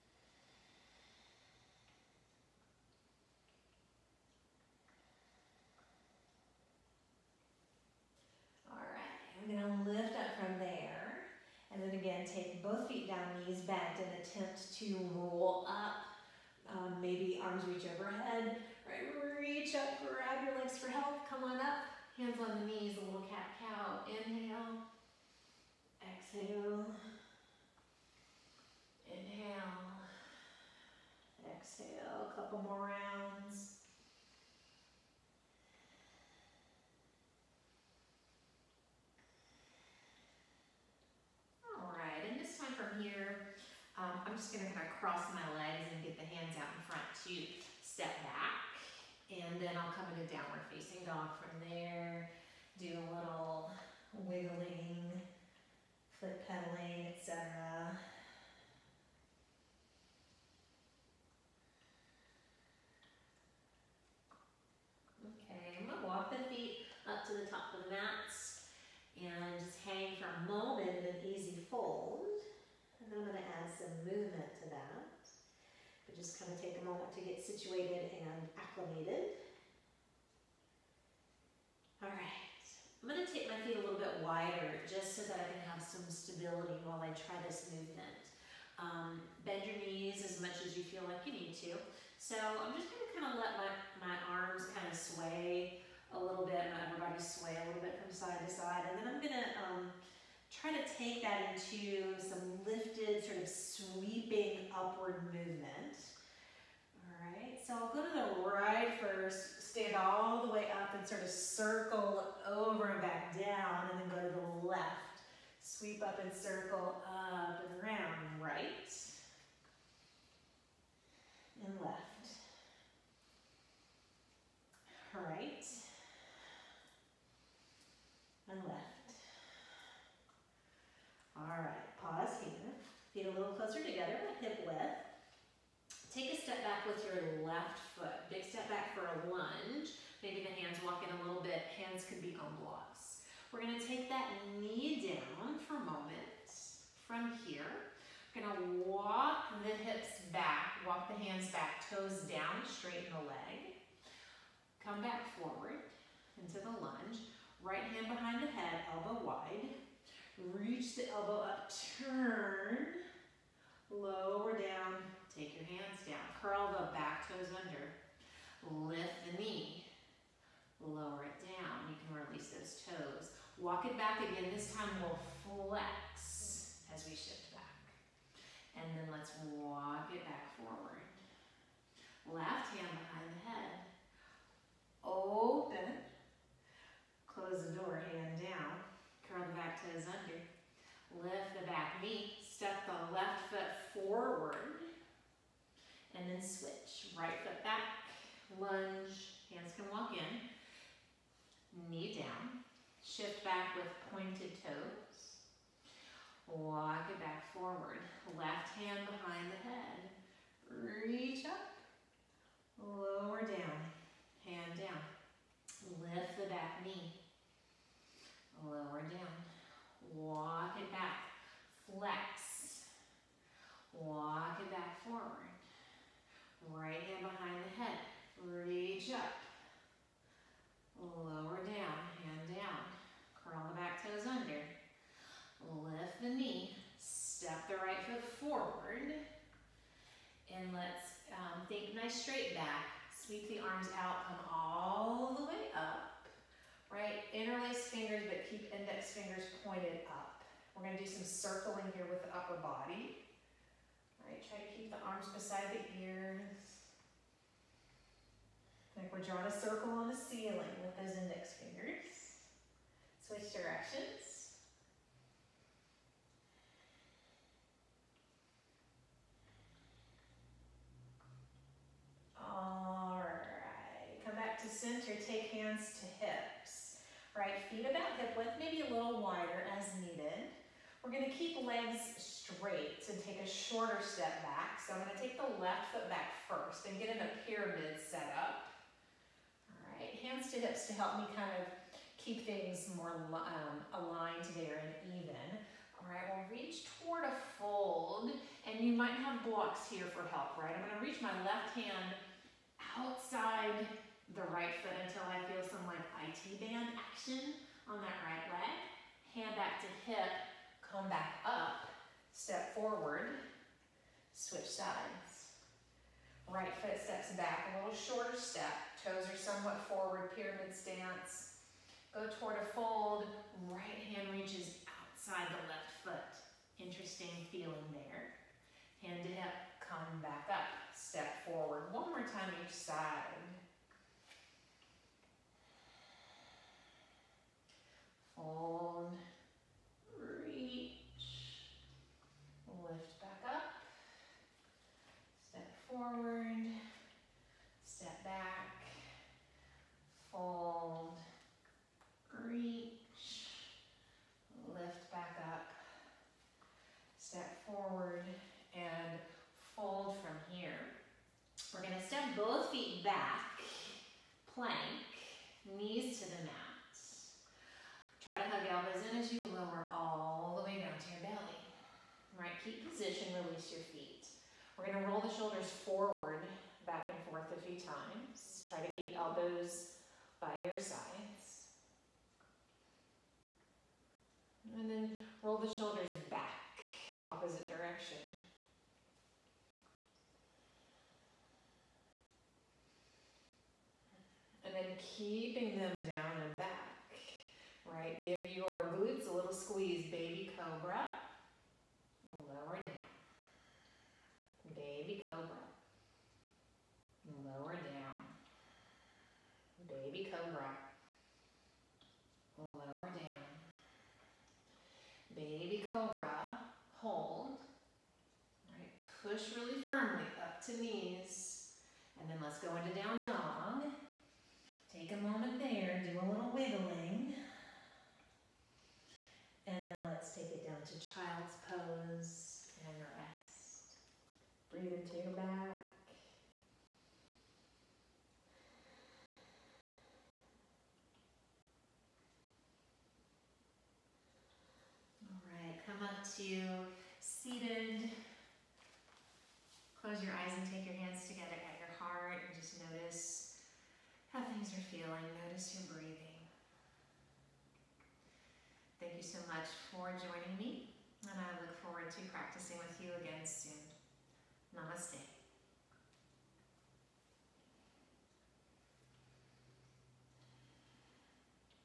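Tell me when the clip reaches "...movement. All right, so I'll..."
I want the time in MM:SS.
01:45.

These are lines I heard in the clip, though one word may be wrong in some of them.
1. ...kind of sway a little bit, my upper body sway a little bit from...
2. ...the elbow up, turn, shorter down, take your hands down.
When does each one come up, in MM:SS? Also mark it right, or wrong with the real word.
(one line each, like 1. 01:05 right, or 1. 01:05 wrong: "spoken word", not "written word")
1. 01:34 right
2. 02:40 wrong: "lower", not "shorter".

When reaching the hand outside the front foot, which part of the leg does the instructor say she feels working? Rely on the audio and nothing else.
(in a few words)
IT band.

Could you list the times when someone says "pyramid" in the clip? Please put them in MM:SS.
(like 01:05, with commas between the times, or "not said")
04:47, 05:20.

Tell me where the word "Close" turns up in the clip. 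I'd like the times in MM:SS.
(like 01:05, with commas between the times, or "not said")
03:07, 07:30.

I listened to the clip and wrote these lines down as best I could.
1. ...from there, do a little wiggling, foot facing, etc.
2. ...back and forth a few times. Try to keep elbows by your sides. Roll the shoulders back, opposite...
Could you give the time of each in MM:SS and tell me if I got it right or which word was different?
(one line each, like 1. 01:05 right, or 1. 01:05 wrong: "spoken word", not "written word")
1. 00:51 wrong: "pedaling", not "facing"
2. 06:16 right.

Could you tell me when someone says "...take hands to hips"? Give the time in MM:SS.
04:35.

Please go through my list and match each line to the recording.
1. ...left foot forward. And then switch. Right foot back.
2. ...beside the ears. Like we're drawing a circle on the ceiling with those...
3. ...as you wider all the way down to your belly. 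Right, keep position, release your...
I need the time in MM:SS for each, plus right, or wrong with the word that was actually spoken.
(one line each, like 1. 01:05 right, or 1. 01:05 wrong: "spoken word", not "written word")
1. 03:13 right
2. 04:15 right
3. 06:09 wrong: "lower", not "wider".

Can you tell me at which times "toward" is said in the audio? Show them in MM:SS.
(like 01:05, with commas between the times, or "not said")
04:57, 05:22.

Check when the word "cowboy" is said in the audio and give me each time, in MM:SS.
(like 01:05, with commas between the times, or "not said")
not said.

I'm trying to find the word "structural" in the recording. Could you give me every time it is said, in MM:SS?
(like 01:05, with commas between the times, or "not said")
not said.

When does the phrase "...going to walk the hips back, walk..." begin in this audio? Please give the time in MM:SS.
02:28.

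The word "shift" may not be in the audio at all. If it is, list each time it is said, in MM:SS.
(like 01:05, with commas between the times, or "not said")
02:57, 03:23.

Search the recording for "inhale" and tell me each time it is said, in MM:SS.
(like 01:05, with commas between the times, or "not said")
00:24, 00:29.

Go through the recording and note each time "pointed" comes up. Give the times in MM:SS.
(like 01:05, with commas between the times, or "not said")
03:24, 04:09.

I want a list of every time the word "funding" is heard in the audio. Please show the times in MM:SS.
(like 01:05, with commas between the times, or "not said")
not said.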